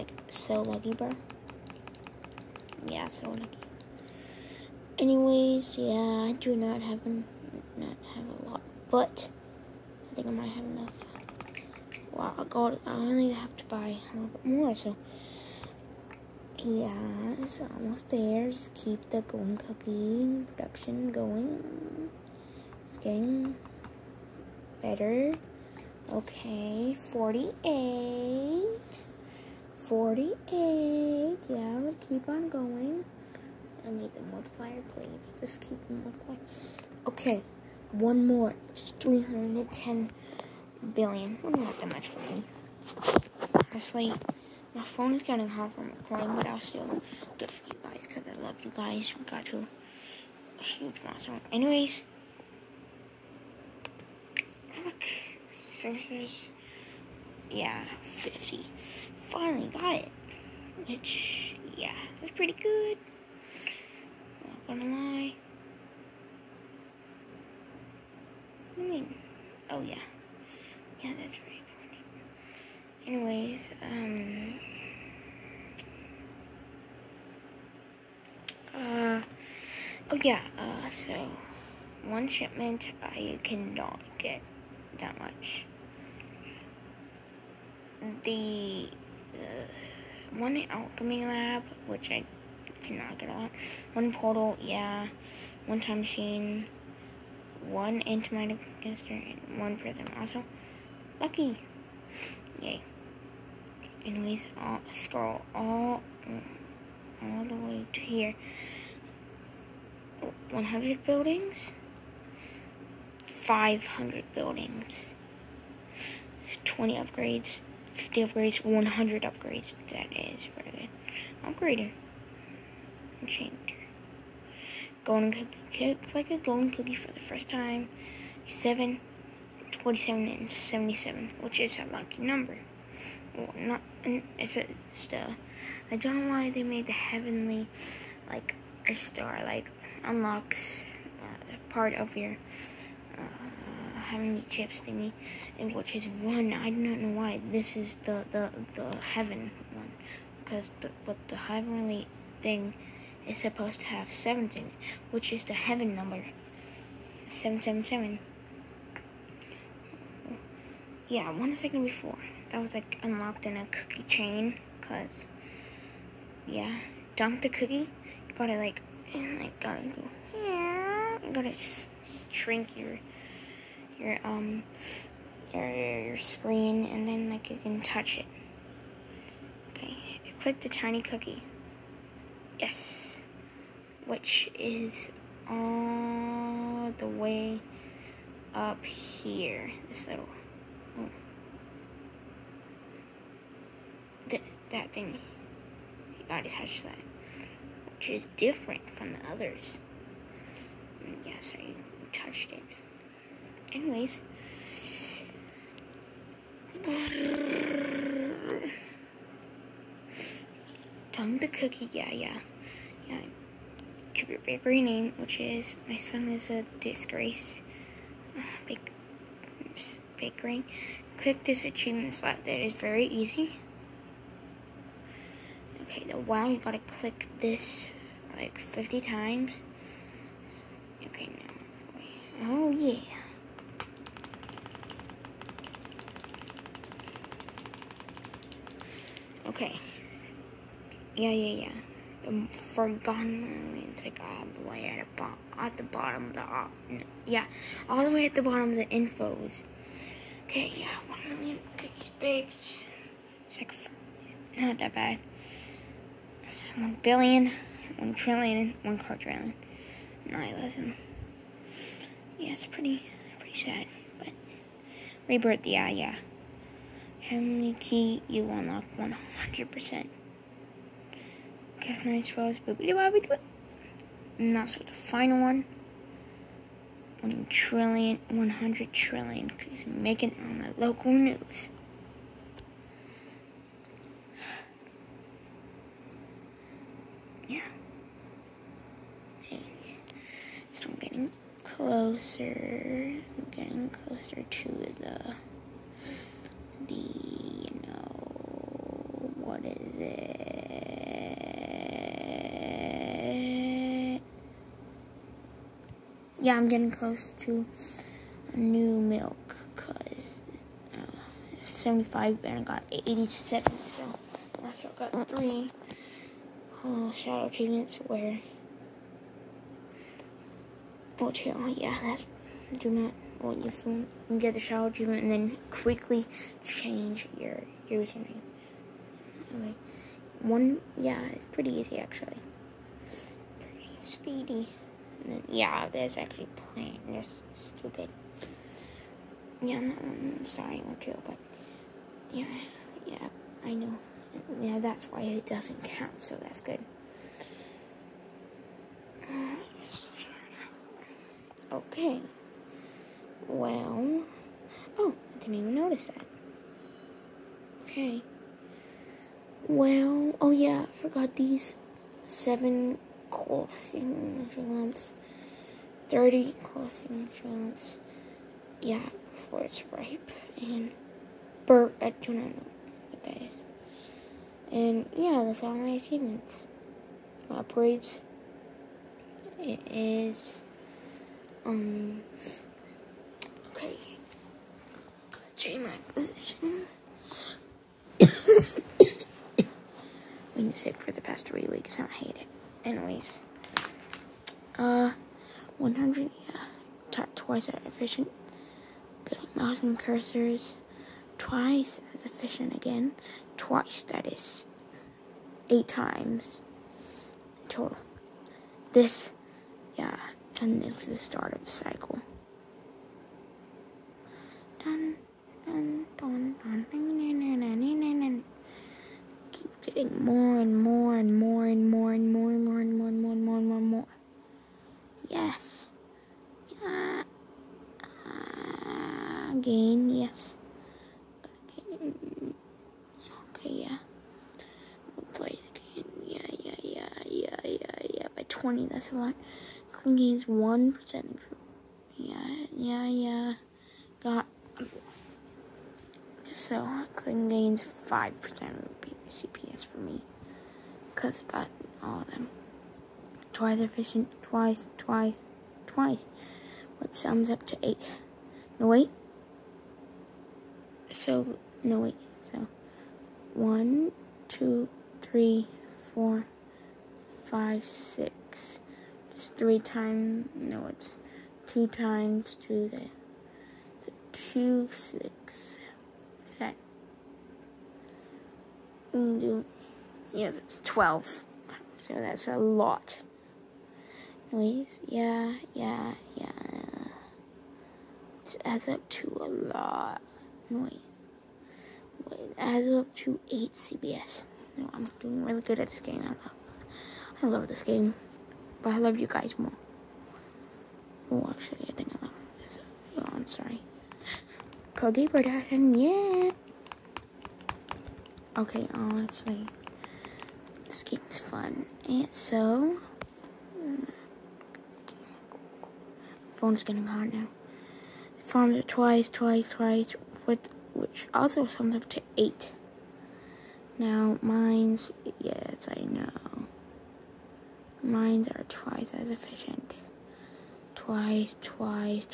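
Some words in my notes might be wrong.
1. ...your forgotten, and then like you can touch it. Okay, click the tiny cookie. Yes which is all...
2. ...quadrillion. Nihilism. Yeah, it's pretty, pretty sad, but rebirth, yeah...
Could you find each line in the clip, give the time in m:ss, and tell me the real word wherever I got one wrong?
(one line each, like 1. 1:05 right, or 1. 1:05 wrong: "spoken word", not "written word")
1. 2:56 wrong: "screen", not "forgotten"
2. 4:20 right.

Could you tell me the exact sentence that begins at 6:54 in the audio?
Dun, dun, dun, Keep getting more and more.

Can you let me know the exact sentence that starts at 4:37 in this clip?
1 trillion, 100 trillion, because I'm making on the local news.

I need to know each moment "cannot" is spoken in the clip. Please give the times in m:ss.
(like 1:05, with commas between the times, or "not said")
1:23, 1:32.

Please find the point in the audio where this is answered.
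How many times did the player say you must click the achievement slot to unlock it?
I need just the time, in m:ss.
3:48.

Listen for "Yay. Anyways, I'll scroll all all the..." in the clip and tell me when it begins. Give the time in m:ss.
1:42.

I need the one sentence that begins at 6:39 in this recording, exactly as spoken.
The mouse and cursors, twice as efficient again.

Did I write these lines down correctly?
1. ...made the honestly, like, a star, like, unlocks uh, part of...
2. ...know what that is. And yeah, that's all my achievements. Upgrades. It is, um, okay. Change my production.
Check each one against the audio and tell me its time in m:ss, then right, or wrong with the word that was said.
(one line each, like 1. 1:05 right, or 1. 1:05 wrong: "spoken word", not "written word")
1. 2:16 wrong: "heavenly", not "honestly"
2. 6:12 wrong: "position", not "production".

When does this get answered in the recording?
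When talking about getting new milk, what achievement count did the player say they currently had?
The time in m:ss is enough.
5:12.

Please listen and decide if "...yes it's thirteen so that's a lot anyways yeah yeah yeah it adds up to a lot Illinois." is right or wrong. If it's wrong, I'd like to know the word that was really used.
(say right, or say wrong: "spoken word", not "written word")
wrong: "twelve", not "thirteen".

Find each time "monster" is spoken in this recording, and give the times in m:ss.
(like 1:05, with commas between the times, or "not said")
0:51.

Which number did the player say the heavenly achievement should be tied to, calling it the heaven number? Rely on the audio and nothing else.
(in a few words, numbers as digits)
17.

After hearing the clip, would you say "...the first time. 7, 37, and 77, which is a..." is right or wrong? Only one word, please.
wrong.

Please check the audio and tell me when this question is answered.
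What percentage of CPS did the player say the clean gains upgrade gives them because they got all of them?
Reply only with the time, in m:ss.
7:28.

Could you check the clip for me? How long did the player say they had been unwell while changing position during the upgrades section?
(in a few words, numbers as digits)
three weeks.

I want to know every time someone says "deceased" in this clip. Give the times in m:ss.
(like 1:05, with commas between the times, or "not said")
not said.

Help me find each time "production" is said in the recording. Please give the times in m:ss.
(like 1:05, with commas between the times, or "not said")
0:20, 8:25.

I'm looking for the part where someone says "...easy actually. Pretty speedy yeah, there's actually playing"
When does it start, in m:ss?
5:31.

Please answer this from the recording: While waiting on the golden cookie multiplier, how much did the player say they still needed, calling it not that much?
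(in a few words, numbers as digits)
310 billion.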